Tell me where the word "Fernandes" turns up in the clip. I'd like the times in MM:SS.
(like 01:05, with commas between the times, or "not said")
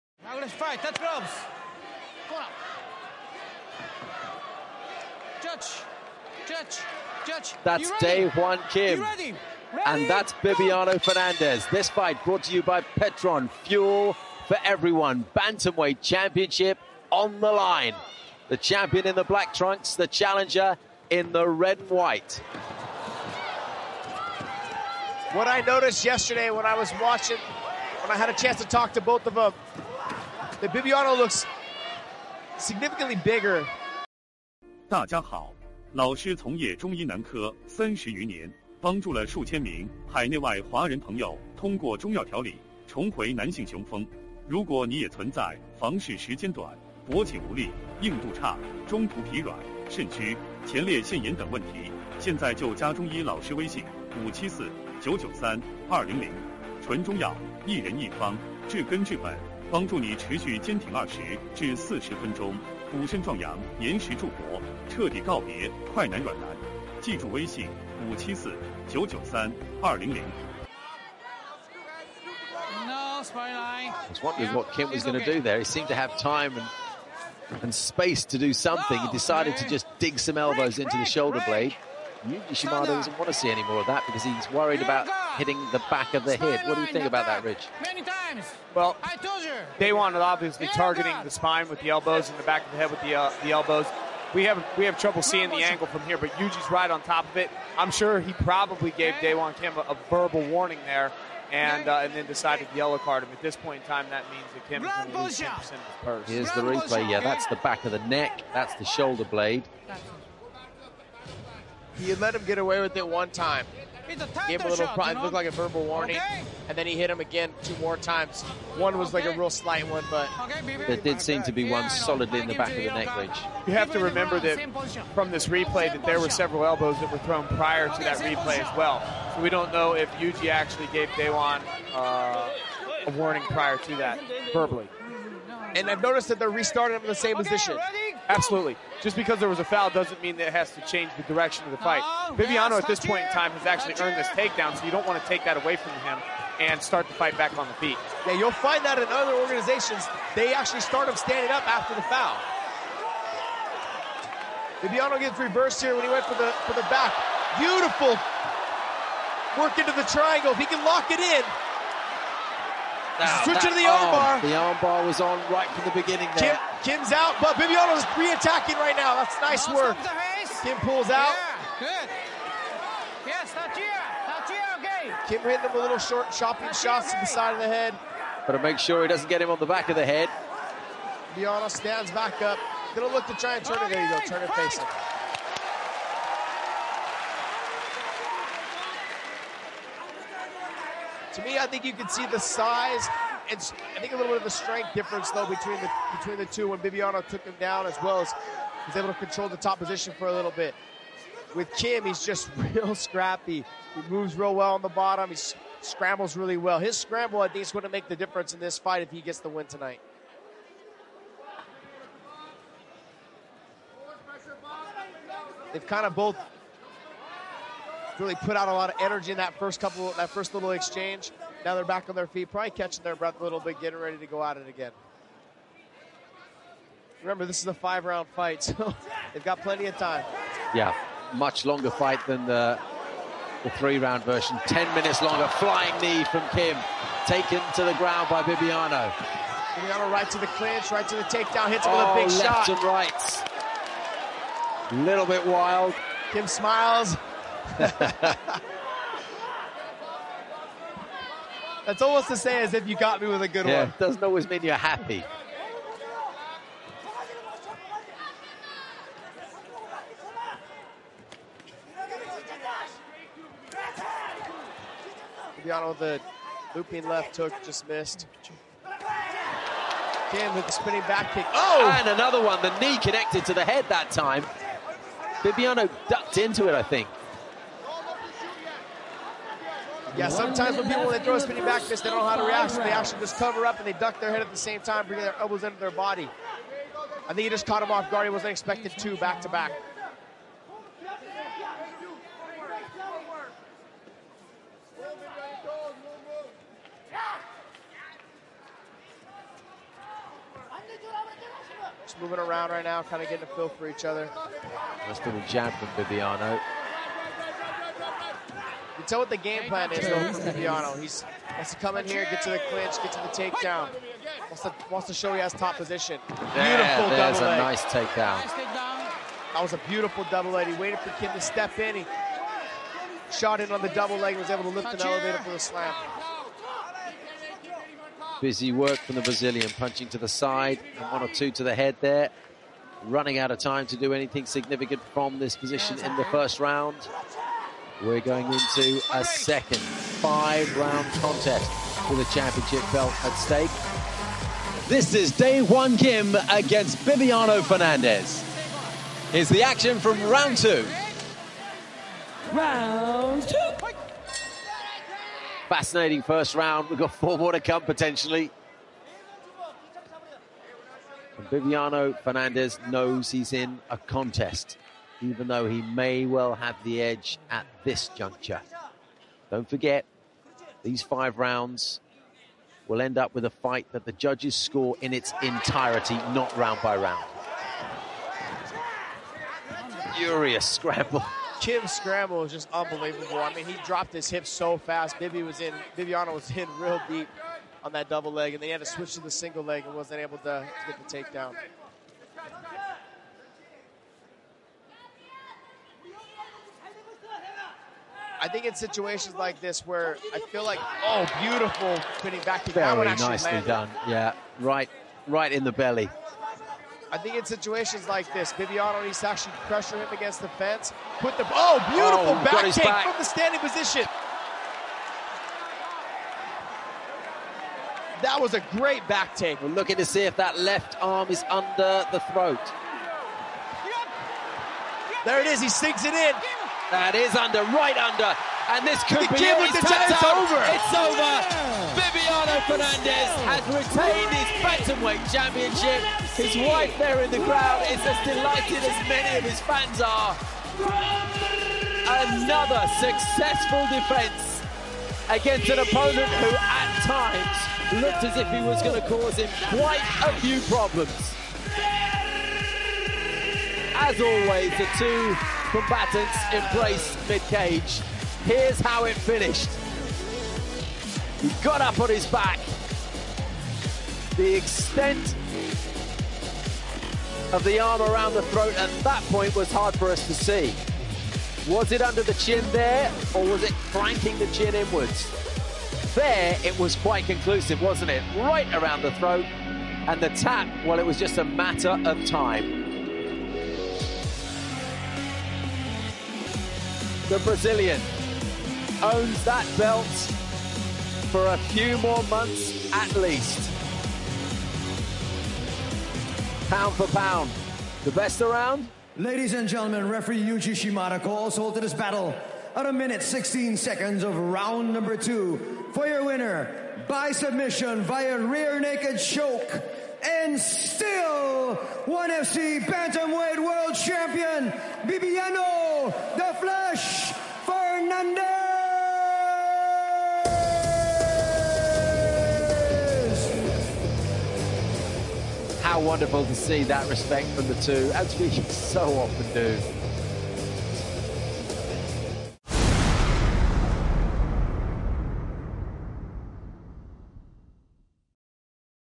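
00:11, 05:47, 06:02, 07:12.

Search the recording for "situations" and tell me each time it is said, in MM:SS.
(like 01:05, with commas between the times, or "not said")
06:38, 06:47.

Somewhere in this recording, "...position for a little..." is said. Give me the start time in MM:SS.
03:19.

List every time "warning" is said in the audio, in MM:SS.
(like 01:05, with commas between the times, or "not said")
01:40, 01:55, 02:13.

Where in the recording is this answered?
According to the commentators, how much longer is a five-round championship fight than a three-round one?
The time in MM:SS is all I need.
03:54.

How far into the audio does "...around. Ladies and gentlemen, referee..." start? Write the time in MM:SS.
08:18.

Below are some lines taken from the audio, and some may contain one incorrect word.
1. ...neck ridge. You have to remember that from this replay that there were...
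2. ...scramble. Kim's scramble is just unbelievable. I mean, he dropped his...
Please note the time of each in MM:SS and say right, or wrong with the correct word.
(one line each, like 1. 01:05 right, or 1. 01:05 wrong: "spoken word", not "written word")
1. 02:02 right
2. 06:20 right.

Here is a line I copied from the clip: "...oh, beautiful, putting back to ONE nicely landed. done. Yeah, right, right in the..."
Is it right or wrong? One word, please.
wrong.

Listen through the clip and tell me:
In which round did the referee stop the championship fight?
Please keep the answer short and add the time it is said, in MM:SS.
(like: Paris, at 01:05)
Round 2, at 08:24.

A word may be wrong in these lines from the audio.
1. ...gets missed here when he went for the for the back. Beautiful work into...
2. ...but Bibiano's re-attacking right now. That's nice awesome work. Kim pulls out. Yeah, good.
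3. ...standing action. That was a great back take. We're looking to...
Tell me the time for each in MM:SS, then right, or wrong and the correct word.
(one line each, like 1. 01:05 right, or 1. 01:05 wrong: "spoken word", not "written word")
1. 02:35 wrong: "reversed", not "missed"
2. 02:47 right
3. 06:53 wrong: "position", not "action".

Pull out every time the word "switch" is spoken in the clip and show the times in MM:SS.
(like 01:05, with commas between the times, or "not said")
02:43, 06:28.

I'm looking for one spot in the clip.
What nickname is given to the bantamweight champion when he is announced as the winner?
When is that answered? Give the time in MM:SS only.
08:36.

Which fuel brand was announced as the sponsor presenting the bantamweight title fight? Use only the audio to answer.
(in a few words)
Petron.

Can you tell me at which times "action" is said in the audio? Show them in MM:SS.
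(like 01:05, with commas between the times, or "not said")
05:49.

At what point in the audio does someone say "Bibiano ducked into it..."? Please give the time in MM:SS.
04:35.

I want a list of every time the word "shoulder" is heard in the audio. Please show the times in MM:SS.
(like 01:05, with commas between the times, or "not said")
01:21, 01:48.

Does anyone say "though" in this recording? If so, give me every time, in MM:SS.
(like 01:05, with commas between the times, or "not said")
03:15, 05:09, 06:05.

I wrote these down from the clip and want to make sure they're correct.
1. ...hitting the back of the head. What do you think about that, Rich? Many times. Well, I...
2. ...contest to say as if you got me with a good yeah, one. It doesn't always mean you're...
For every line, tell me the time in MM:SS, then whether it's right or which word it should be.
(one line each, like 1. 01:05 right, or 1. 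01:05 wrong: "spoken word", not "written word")
1. 01:25 right
2. 04:12 wrong: "almost", not "contest".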